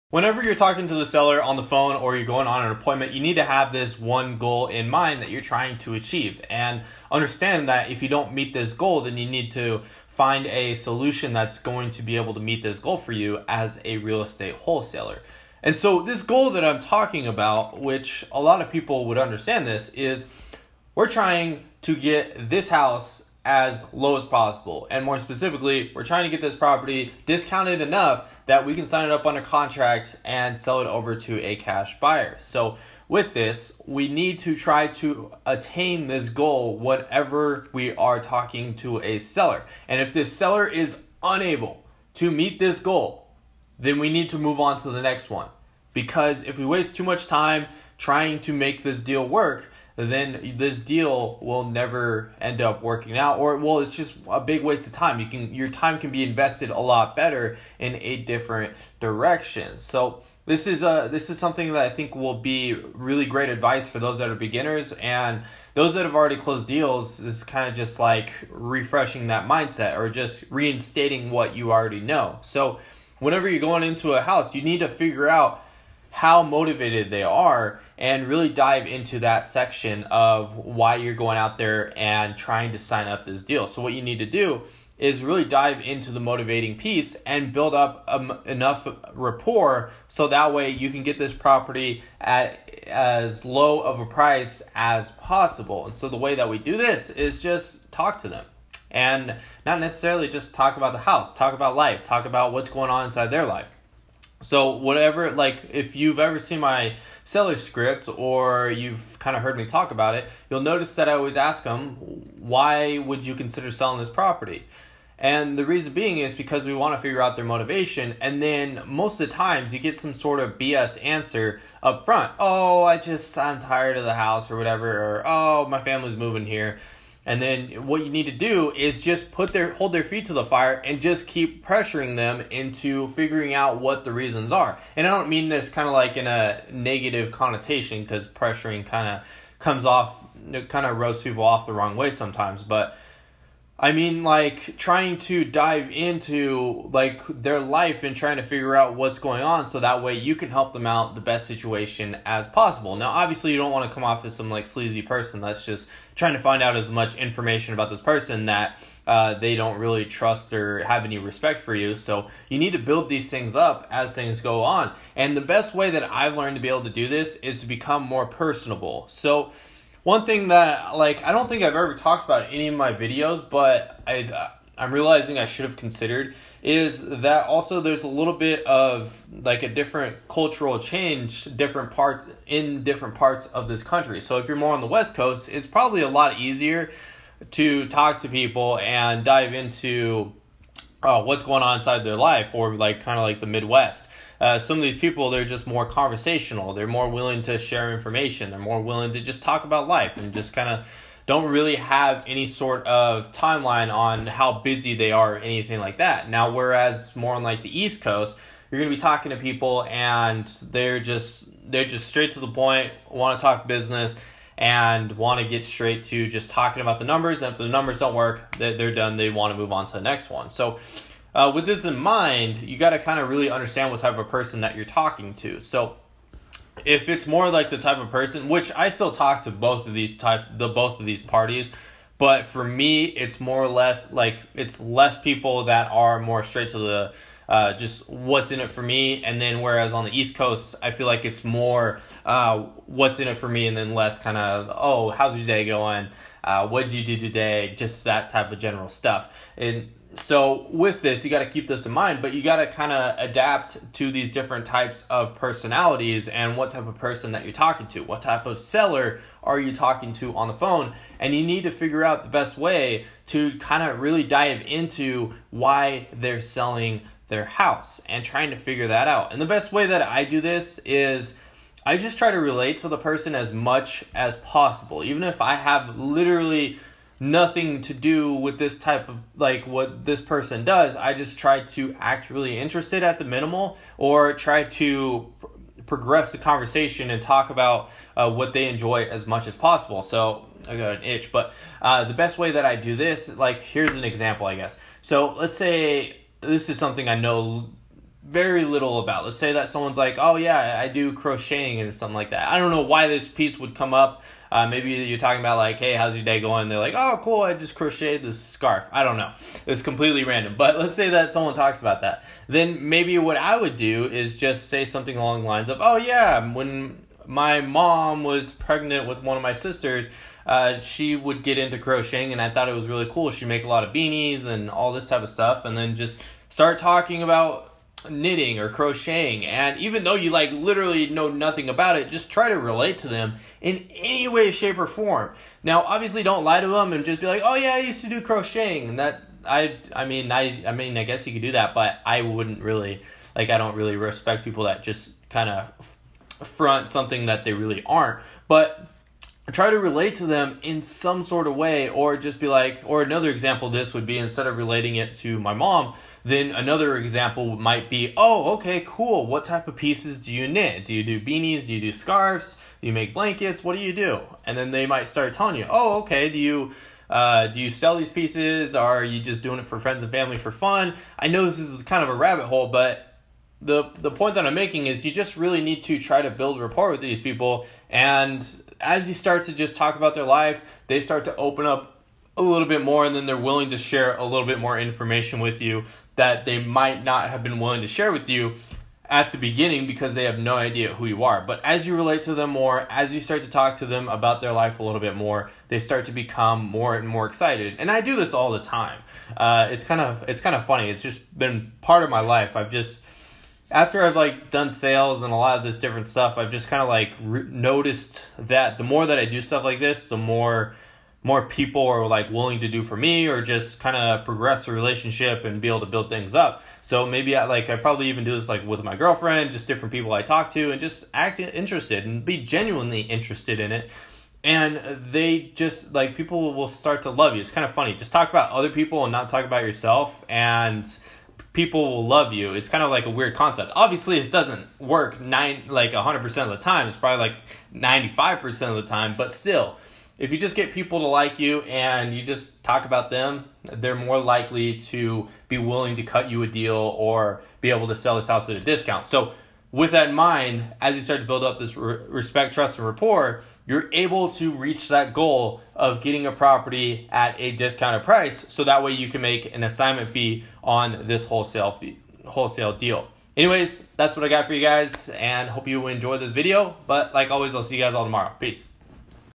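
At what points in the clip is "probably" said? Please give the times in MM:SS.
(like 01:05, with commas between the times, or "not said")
03:05, 06:57, 07:16.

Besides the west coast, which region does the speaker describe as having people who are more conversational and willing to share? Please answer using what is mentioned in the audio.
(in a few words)
The Midwest.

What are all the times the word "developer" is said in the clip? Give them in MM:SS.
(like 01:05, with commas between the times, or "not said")
not said.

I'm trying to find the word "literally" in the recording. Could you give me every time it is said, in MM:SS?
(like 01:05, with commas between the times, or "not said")
04:35, 05:30.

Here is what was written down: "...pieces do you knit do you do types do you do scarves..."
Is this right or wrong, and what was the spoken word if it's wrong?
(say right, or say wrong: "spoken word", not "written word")
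wrong: "beanies", not "types".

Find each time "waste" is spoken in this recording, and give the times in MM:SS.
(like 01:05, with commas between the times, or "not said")
00:46, 00:54.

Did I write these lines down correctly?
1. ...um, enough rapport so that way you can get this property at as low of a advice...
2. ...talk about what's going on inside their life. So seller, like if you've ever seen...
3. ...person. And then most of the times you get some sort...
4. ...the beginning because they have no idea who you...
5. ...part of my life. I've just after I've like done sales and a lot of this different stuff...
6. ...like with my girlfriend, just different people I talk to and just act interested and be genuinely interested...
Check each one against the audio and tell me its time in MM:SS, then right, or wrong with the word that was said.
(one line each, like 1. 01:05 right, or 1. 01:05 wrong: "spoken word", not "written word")
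1. 01:28 wrong: "price", not "advice"
2. 01:42 wrong: "whatever", not "seller"
3. 01:57 wrong: "motivation", not "person"
4. 06:29 right
5. 06:41 right
6. 06:58 right.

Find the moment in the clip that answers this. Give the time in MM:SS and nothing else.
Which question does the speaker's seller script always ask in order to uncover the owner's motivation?
01:52.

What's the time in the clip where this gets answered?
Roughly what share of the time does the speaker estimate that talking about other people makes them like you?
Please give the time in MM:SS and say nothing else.
07:17.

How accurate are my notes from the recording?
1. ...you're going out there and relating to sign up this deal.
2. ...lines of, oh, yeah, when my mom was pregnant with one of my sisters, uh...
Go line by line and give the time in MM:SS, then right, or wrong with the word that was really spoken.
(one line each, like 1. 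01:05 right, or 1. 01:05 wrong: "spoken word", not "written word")
1. 01:20 wrong: "trying", not "relating"
2. 05:15 right.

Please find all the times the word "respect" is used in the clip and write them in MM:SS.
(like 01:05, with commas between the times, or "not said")
02:41, 05:43, 07:32.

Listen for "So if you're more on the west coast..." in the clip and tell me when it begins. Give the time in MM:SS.
03:04.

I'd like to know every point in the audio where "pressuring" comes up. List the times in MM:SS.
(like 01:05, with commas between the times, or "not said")
02:11, 02:18.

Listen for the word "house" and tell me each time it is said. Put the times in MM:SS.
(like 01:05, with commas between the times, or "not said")
00:22, 01:14, 01:40, 02:04, 04:27, 07:28.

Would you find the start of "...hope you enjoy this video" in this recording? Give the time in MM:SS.
07:45.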